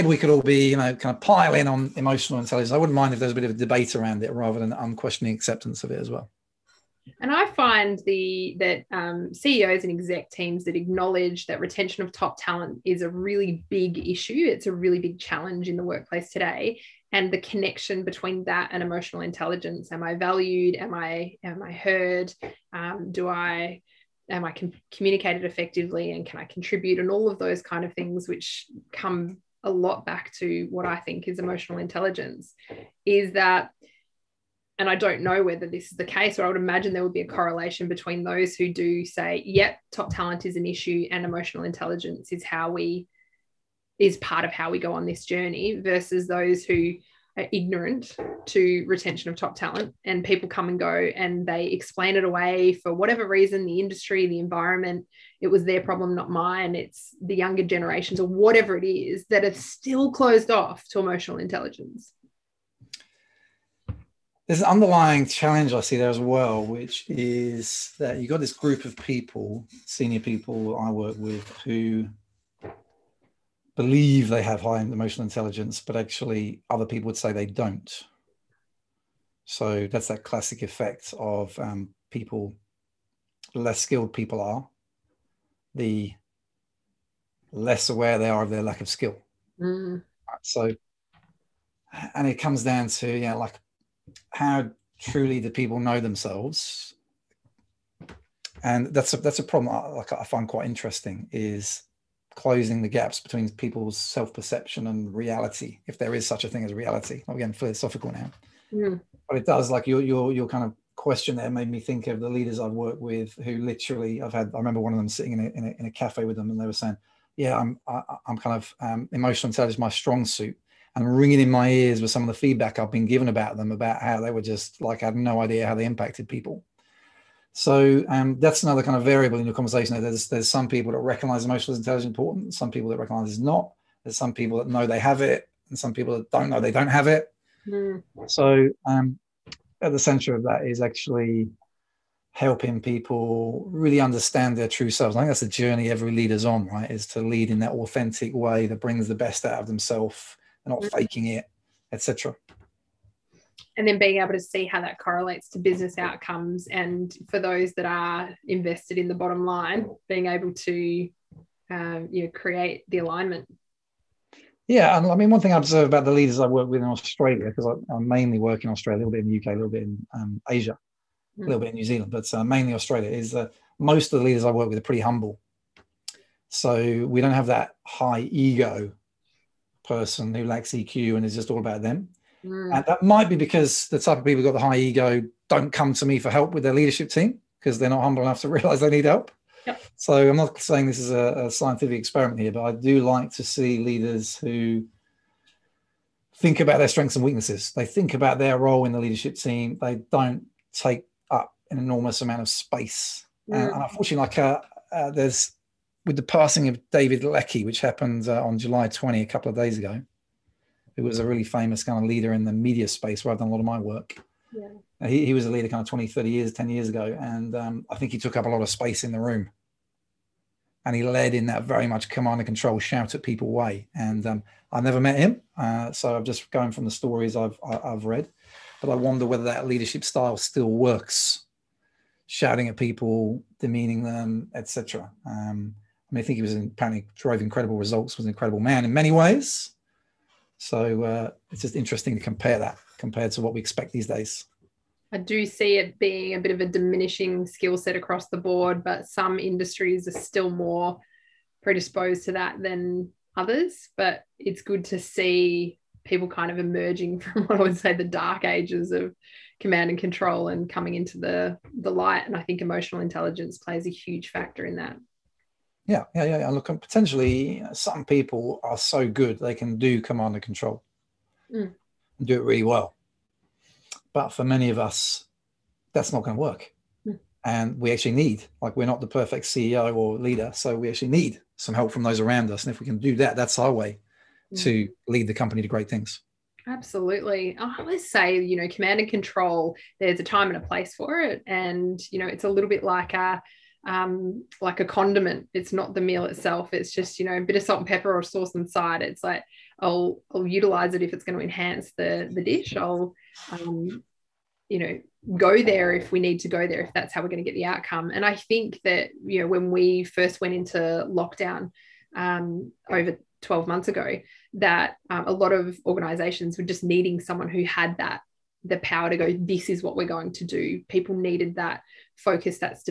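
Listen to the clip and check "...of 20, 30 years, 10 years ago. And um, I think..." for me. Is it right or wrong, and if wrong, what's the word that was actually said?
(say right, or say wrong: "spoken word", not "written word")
right.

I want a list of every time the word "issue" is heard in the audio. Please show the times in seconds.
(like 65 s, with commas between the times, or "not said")
14 s, 40 s.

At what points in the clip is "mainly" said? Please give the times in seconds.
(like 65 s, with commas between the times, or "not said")
167 s, 172 s.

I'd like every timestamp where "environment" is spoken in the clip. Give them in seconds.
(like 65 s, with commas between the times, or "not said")
54 s.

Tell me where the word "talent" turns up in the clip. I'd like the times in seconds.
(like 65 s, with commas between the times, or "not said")
12 s, 40 s, 49 s.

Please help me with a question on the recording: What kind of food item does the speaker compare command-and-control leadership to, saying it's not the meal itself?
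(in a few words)
condiment.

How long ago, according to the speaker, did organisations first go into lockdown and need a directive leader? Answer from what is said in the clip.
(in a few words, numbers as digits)
over 12 months ago.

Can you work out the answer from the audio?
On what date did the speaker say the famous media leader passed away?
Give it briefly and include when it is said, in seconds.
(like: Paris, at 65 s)
July 20, at 208 s.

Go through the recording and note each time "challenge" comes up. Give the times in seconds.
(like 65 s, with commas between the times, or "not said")
15 s, 65 s.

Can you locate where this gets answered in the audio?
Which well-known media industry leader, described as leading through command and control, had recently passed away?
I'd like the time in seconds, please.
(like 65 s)
206 s.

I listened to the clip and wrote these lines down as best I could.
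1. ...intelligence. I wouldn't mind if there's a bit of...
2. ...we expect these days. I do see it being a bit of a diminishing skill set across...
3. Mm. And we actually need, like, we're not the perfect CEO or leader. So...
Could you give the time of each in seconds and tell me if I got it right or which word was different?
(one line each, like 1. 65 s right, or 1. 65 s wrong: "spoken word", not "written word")
1. 2 s right
2. 243 s right
3. 277 s right.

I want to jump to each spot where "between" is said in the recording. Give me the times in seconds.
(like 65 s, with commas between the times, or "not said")
18 s, 37 s, 103 s.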